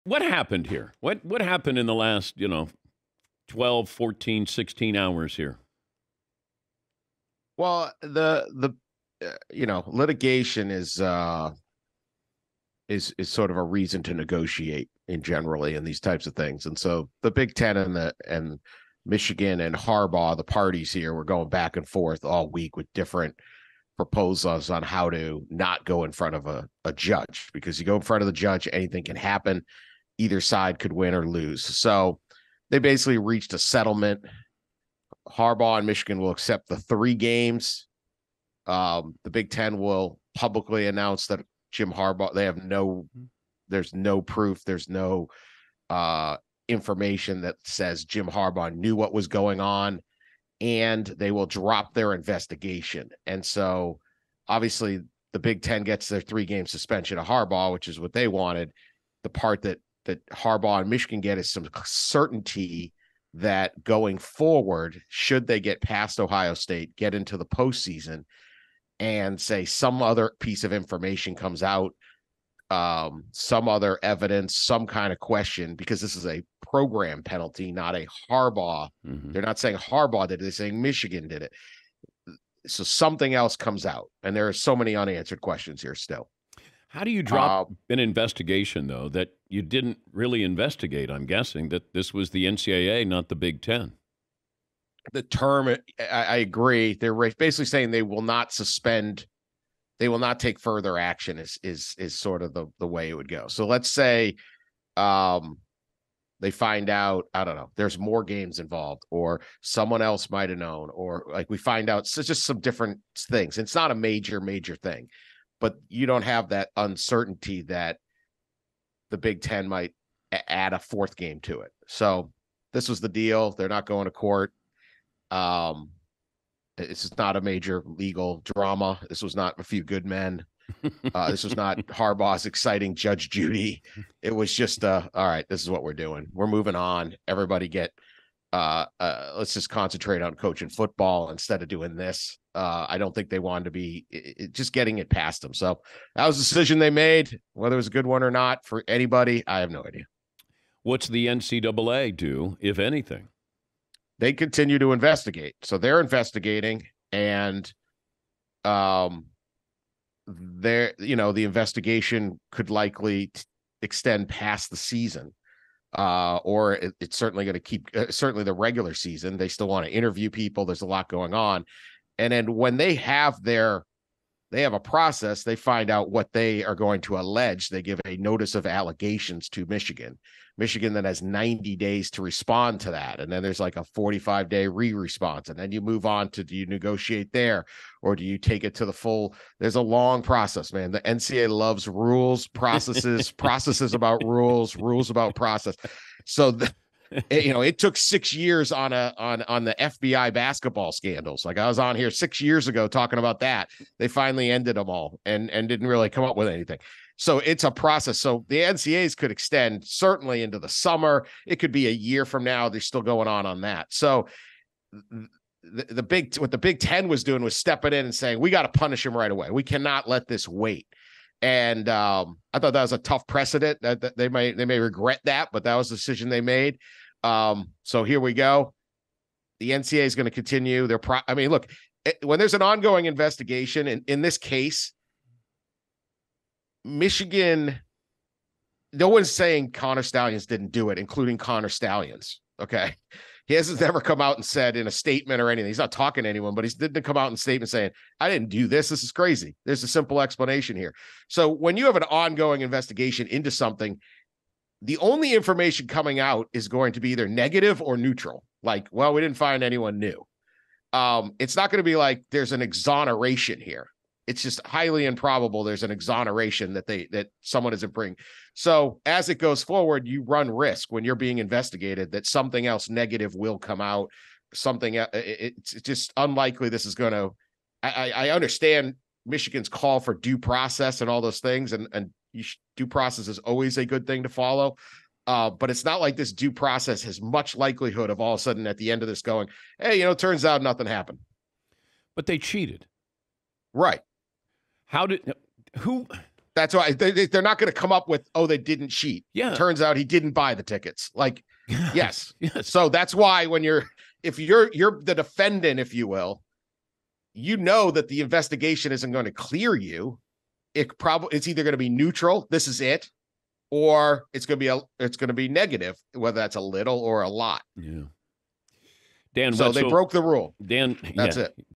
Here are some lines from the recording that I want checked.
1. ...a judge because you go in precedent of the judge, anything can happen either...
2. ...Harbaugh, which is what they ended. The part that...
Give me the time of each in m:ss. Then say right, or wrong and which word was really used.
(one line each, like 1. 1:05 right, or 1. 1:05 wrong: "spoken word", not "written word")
1. 0:26 wrong: "front", not "precedent"
2. 0:57 wrong: "wanted", not "ended".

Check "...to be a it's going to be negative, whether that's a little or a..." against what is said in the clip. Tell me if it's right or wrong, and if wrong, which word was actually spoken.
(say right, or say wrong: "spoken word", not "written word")
right.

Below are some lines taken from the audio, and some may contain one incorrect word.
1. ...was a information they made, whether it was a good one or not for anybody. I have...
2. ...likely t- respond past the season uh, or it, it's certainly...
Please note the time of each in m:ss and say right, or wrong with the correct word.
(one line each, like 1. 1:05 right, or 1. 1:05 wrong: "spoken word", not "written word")
1. 2:26 wrong: "decision", not "information"
2. 2:42 wrong: "extend", not "respond".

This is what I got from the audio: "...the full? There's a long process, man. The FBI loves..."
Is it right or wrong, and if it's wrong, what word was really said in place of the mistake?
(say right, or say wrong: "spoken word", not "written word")
wrong: "NCAA", not "FBI".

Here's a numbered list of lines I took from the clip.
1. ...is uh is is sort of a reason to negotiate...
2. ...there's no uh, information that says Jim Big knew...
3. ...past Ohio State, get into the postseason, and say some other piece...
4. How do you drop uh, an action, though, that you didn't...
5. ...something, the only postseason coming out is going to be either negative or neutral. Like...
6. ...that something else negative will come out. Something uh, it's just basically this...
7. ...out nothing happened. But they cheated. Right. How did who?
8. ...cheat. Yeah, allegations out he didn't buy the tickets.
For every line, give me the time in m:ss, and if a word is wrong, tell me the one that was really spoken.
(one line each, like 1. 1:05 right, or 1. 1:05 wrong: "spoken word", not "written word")
1. 0:10 right
2. 0:44 wrong: "Harbaugh", not "Big"
3. 1:05 right
4. 1:26 wrong: "investigation", not "action"
5. 4:13 wrong: "information", not "postseason"
6. 4:32 wrong: "unlikely", not "basically"
7. 4:50 right
8. 4:58 wrong: "turns", not "allegations".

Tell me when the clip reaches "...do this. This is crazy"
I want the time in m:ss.
4:08.